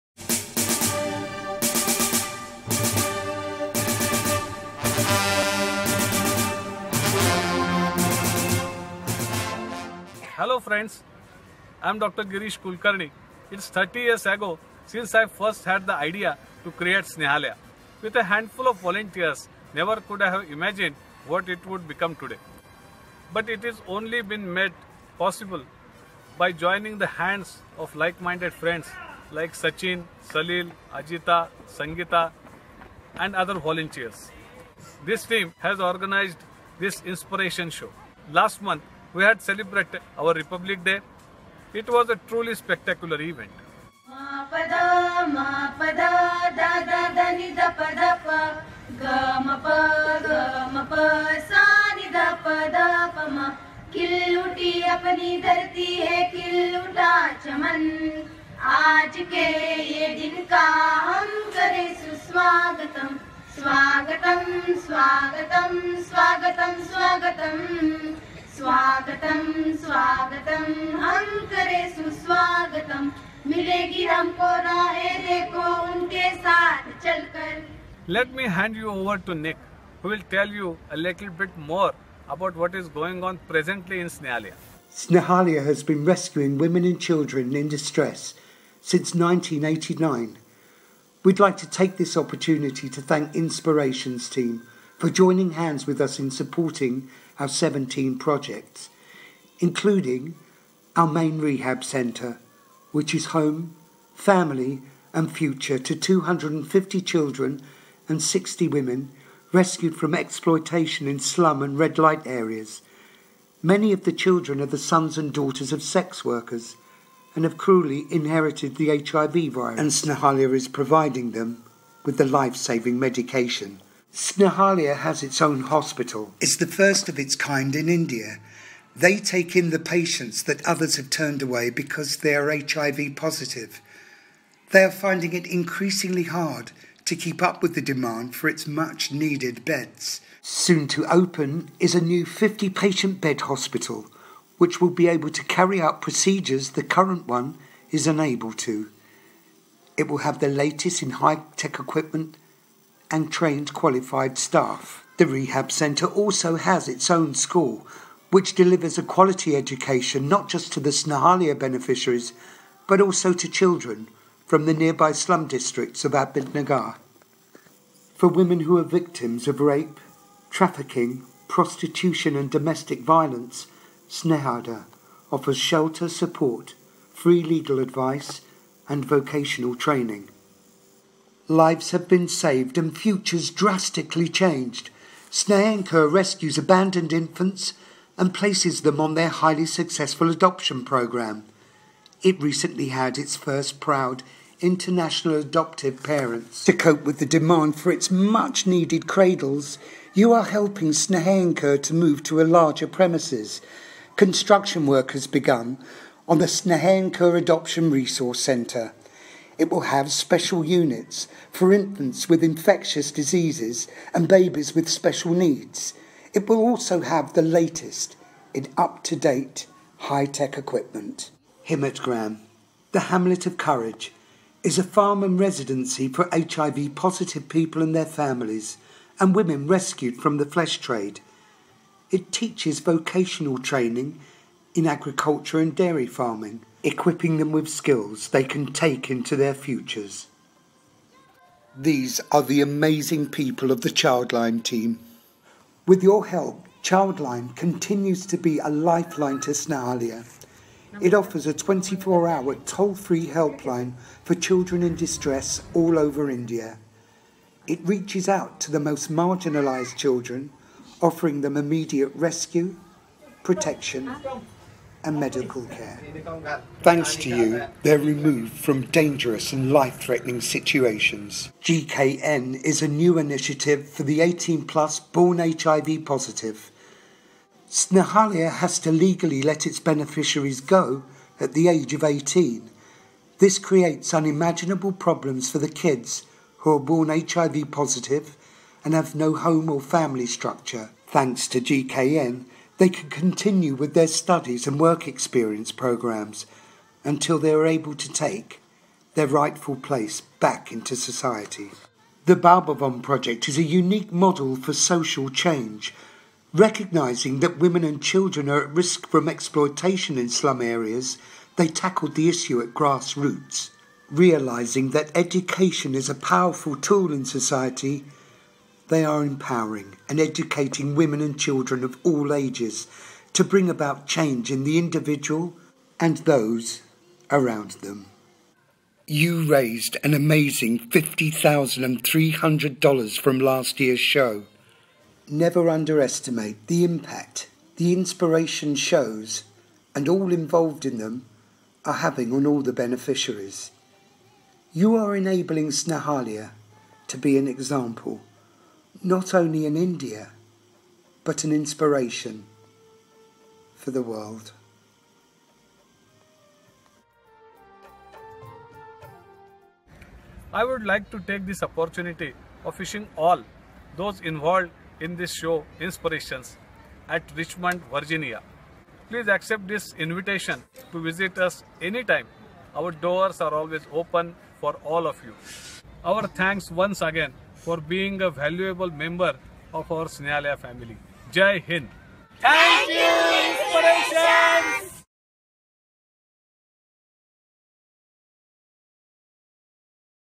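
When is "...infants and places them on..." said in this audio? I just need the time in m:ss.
3:07.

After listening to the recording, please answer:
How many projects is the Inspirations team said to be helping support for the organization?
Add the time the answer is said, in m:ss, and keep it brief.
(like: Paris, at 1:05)
17, at 1:37.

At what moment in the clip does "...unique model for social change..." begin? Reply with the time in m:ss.
5:03.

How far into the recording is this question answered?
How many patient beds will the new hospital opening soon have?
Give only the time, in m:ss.
2:22.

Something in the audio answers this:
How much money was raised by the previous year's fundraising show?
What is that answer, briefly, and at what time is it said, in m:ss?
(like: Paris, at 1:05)
$50,300, at 5:30.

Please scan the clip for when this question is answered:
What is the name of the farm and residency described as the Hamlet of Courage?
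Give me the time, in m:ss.
3:41.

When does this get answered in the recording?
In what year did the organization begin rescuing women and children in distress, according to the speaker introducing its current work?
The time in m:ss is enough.
1:29.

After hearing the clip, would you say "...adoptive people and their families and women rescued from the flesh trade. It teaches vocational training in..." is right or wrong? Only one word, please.
wrong.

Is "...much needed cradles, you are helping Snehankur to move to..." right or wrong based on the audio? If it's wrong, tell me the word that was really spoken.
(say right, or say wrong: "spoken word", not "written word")
right.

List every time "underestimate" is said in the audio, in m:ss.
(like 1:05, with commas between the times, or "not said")
5:35.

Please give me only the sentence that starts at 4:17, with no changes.
It reaches out to the most marginalised children, offering them immediate rescue, protection, and medical care.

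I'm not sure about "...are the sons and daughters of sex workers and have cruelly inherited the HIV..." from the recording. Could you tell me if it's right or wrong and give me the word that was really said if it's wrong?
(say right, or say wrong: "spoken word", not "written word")
right.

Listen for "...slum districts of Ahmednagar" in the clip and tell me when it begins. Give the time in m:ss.
2:45.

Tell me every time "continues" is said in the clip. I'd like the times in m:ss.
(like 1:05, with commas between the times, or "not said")
4:07, 4:53.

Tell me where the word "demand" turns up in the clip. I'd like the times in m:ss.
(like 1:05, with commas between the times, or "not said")
2:17, 3:17.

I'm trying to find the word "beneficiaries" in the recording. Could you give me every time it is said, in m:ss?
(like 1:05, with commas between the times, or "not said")
2:41, 4:39, 5:42.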